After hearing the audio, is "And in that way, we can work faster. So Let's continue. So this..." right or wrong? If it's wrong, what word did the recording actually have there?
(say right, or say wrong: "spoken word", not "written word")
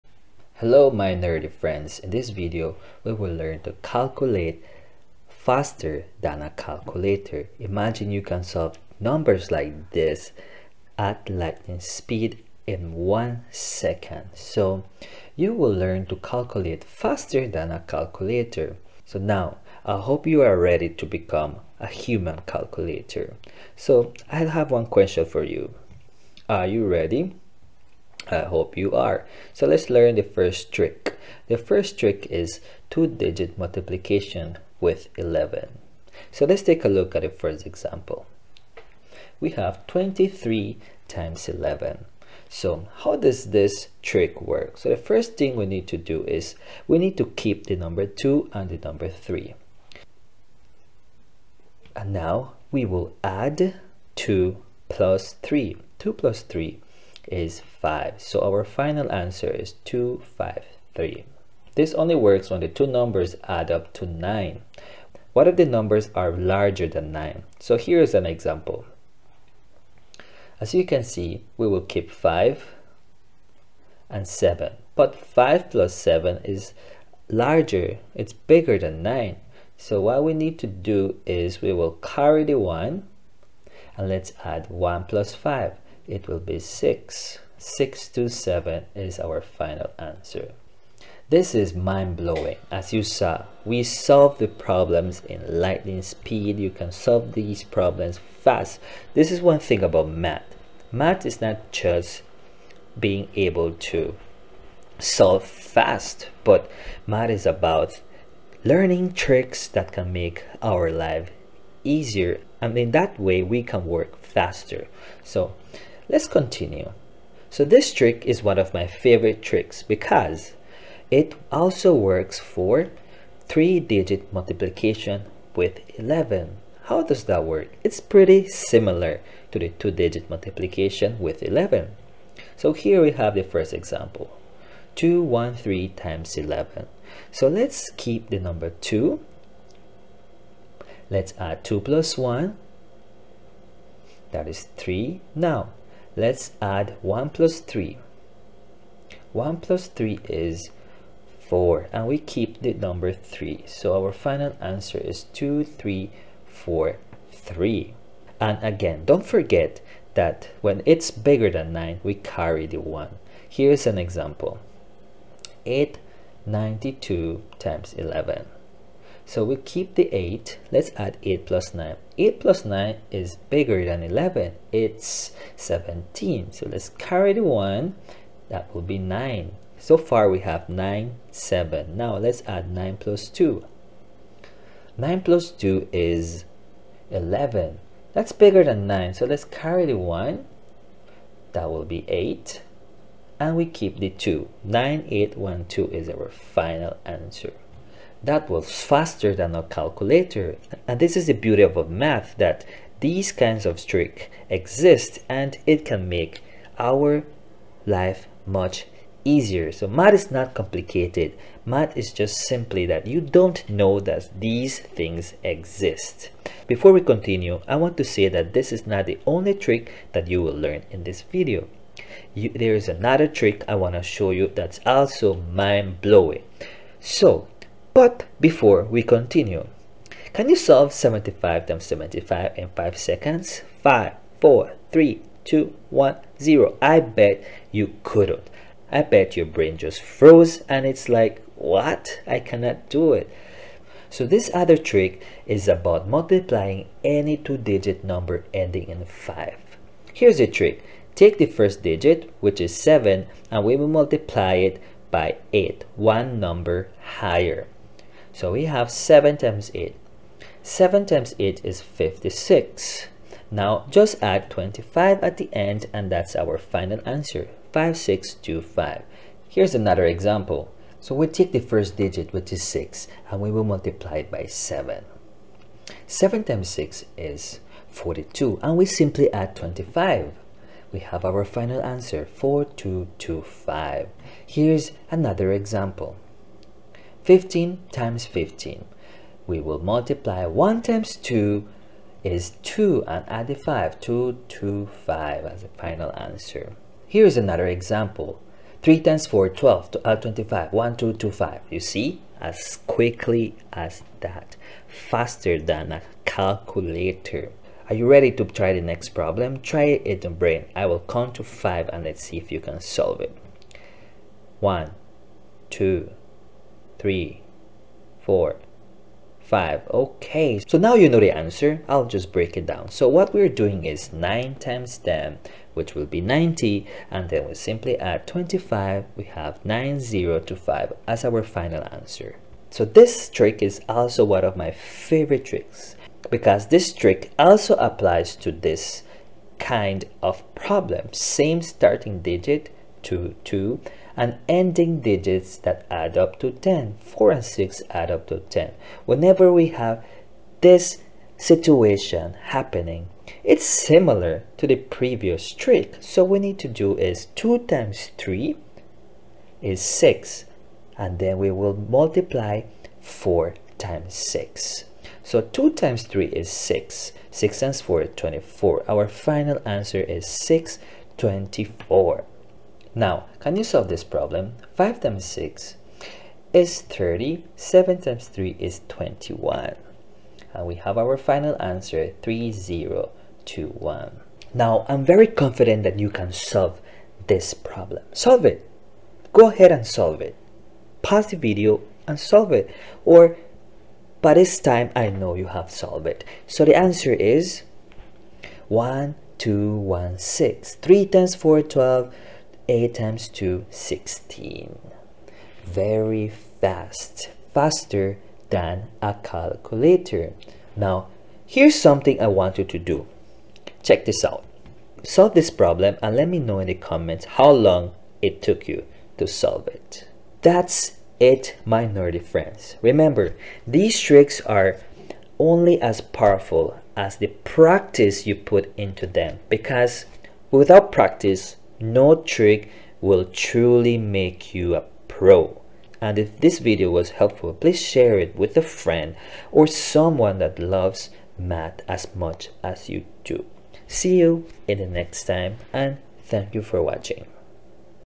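right.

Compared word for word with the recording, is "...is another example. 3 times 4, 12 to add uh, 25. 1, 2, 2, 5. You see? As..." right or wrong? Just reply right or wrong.
right.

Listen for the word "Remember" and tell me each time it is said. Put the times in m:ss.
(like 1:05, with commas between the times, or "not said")
7:02.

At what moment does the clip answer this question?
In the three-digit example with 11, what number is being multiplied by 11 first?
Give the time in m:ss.
2:14.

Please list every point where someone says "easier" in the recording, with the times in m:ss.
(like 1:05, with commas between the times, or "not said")
1:51, 3:29.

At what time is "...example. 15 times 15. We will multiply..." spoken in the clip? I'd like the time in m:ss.
4:45.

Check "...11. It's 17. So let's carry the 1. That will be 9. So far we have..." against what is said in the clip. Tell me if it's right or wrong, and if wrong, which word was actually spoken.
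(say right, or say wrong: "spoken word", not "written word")
right.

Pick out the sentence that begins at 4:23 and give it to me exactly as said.
Now just add 25 at the end and that's our final answer, 5625.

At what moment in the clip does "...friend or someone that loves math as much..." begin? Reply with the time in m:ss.
7:18.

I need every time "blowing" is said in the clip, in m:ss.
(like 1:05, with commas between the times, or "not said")
1:31, 3:45.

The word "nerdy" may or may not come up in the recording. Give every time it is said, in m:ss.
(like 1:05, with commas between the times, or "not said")
0:01, 7:01.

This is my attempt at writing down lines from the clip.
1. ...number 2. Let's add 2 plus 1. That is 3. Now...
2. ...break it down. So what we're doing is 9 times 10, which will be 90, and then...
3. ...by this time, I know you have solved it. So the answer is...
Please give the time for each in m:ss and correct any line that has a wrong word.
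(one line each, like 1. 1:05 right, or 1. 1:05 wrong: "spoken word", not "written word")
1. 2:18 right
2. 5:22 right
3. 6:34 right.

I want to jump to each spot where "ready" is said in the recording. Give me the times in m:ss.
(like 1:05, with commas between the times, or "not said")
0:20, 0:26, 5:08.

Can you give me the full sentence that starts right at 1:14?
But 5 plus 7 is larger, it's bigger than 9.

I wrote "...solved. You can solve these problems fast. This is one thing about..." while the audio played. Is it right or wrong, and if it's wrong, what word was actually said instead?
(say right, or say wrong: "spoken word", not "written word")
wrong: "speed", not "solved".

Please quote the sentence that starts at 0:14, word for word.
So you will learn to calculate faster than a calculator.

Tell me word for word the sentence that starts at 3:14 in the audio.
9, 8, 1, 2 is our final answer that was faster than a calculator.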